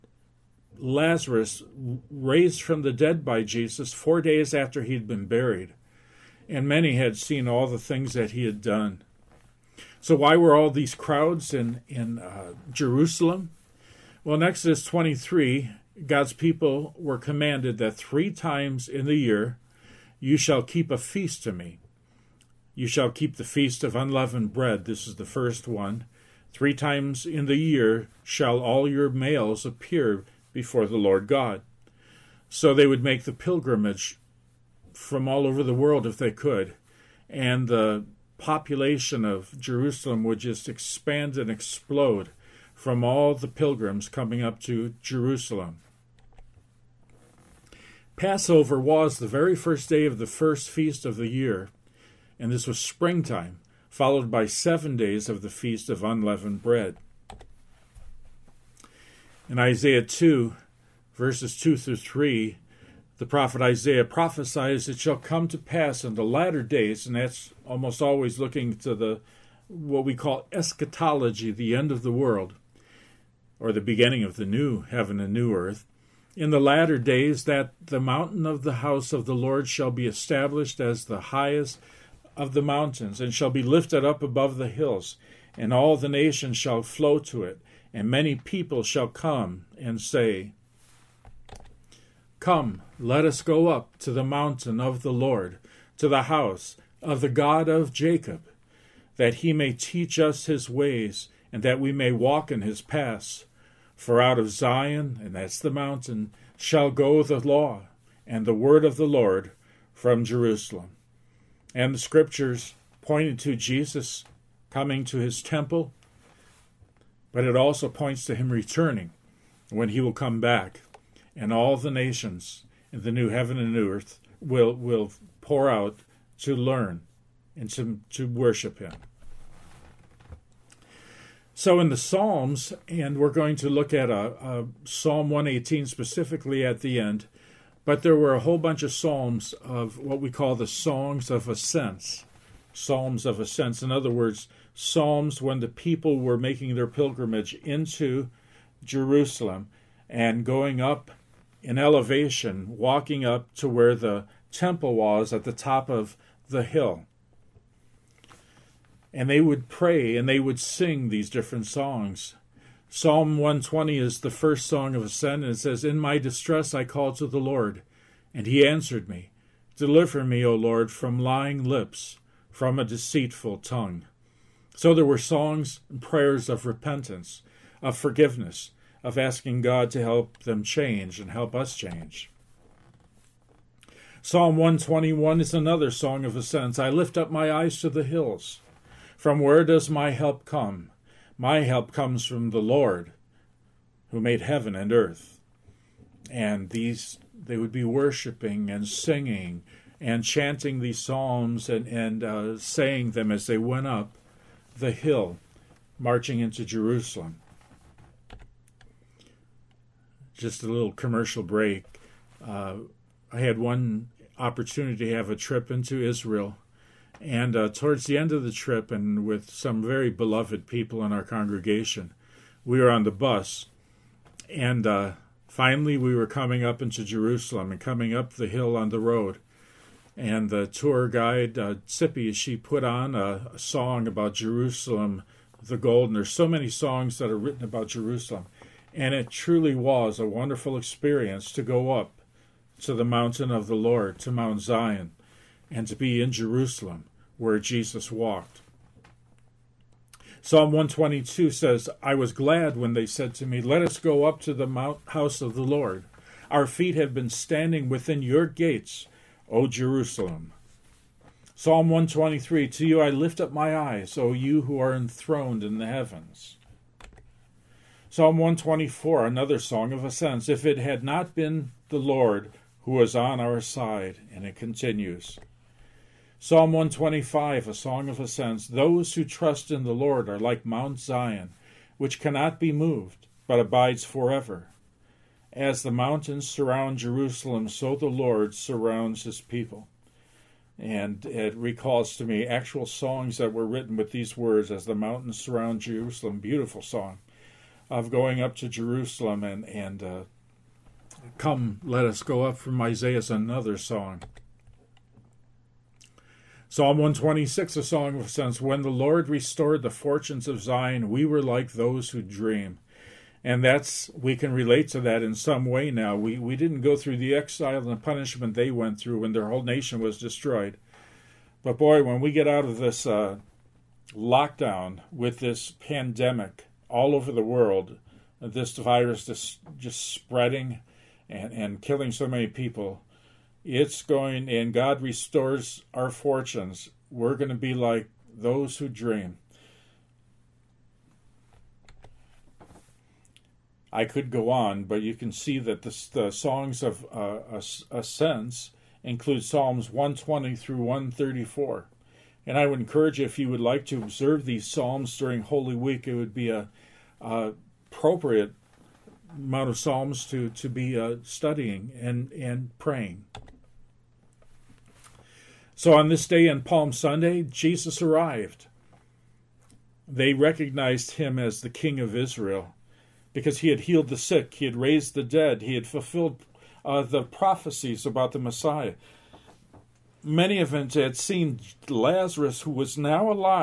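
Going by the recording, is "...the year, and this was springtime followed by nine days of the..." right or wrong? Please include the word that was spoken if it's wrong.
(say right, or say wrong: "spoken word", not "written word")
wrong: "seven", not "nine".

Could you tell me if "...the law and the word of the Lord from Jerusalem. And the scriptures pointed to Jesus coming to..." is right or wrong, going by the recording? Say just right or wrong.
right.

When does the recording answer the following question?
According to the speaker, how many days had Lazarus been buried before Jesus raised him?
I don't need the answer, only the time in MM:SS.
00:03.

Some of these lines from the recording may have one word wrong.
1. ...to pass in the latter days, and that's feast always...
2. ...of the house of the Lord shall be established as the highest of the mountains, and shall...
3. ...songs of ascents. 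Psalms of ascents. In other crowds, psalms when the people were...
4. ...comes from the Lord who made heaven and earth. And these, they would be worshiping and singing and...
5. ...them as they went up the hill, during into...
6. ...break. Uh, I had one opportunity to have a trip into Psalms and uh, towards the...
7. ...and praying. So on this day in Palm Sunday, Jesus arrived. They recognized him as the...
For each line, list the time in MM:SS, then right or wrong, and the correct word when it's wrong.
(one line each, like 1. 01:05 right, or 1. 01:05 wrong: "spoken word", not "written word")
1. 01:05 wrong: "almost", not "feast"
2. 01:18 right
3. 02:20 wrong: "words", not "crowds"
4. 03:11 right
5. 03:23 wrong: "marching", not "during"
6. 03:31 wrong: "Israel", not "Psalms"
7. 06:02 right.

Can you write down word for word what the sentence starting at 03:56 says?
there's so many songs that are written about Jerusalem.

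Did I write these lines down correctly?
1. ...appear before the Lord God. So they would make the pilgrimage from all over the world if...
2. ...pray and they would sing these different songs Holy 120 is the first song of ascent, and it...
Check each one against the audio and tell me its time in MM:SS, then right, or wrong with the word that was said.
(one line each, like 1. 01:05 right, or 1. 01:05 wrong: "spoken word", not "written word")
1. 00:29 right
2. 02:39 wrong: "Psalm", not "Holy".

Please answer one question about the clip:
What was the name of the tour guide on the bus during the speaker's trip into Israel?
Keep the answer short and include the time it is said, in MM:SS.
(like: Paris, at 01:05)
Sippy, at 03:51.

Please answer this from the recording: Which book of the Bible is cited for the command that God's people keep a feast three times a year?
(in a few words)
Exodus 23.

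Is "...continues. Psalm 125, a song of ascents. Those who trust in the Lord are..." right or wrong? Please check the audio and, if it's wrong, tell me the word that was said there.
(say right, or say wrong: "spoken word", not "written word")
right.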